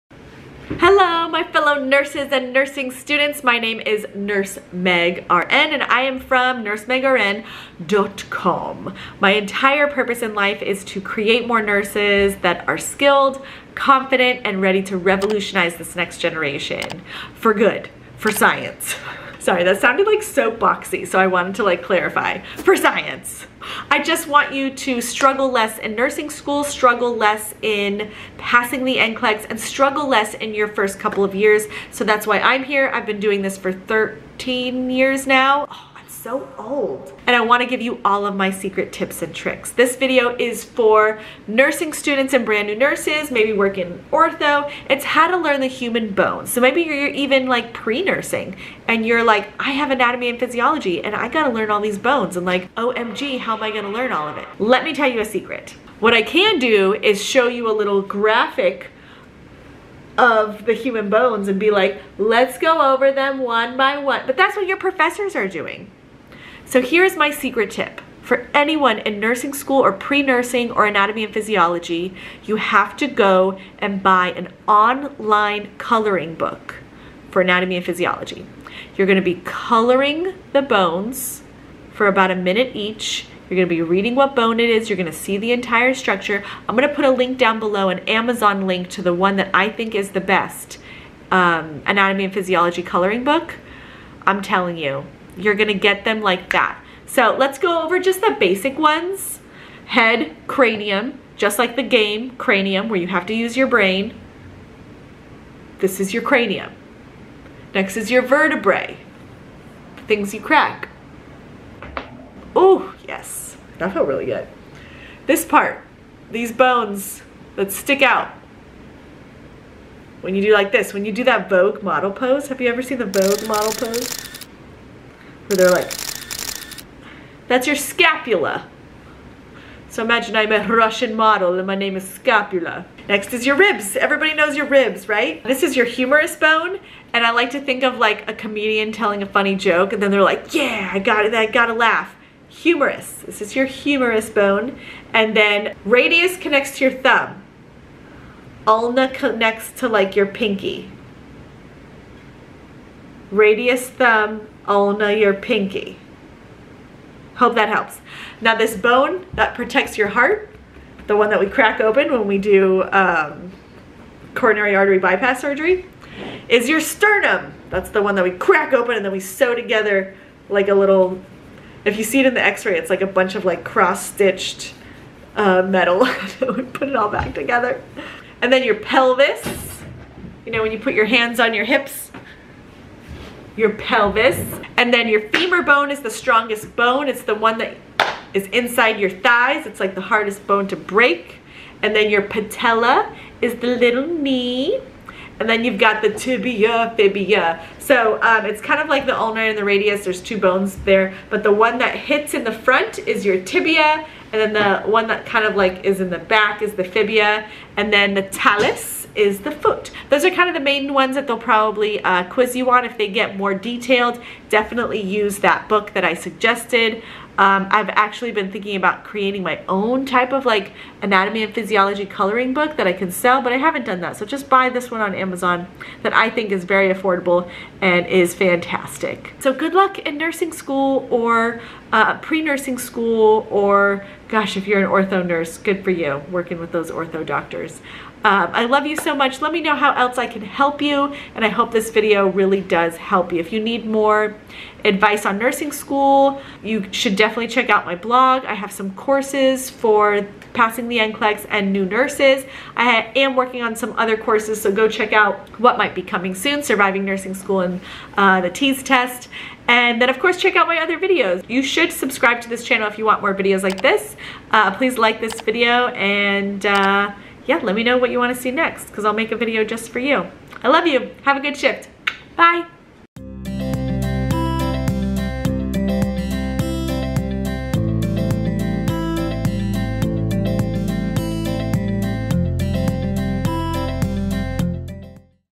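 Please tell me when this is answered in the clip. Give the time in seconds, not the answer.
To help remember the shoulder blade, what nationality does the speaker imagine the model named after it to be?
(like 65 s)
130 s.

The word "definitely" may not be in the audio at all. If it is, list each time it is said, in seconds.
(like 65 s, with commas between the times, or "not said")
214 s, 247 s.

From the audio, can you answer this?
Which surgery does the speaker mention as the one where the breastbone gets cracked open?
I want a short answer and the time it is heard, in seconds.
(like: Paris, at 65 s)
Coronary artery bypass surgery, at 164 s.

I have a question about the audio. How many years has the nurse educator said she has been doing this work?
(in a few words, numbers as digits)
13.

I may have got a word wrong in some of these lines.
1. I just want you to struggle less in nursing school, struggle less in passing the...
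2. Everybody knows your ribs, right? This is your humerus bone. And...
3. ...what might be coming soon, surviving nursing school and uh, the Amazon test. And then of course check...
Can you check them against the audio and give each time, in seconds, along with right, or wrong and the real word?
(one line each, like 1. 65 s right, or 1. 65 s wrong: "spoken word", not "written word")
1. 23 s right
2. 133 s right
3. 255 s wrong: "TEAS", not "Amazon".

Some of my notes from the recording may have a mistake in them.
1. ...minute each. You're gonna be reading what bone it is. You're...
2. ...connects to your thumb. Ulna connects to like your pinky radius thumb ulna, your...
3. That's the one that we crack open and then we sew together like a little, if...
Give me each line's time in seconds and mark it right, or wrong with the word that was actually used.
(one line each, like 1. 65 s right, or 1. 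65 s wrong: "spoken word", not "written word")
1. 82 s right
2. 146 s right
3. 167 s right.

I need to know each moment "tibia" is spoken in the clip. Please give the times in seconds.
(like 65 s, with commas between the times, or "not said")
196 s, 203 s.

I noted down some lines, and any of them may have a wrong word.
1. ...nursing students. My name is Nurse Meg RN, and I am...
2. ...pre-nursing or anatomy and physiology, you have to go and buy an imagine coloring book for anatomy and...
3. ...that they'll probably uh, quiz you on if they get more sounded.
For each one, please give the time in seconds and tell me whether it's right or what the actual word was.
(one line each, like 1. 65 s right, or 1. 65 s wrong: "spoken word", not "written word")
1. 2 s right
2. 69 s wrong: "online", not "imagine"
3. 211 s wrong: "detailed", not "sounded".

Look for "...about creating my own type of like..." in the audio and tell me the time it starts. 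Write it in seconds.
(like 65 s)
218 s.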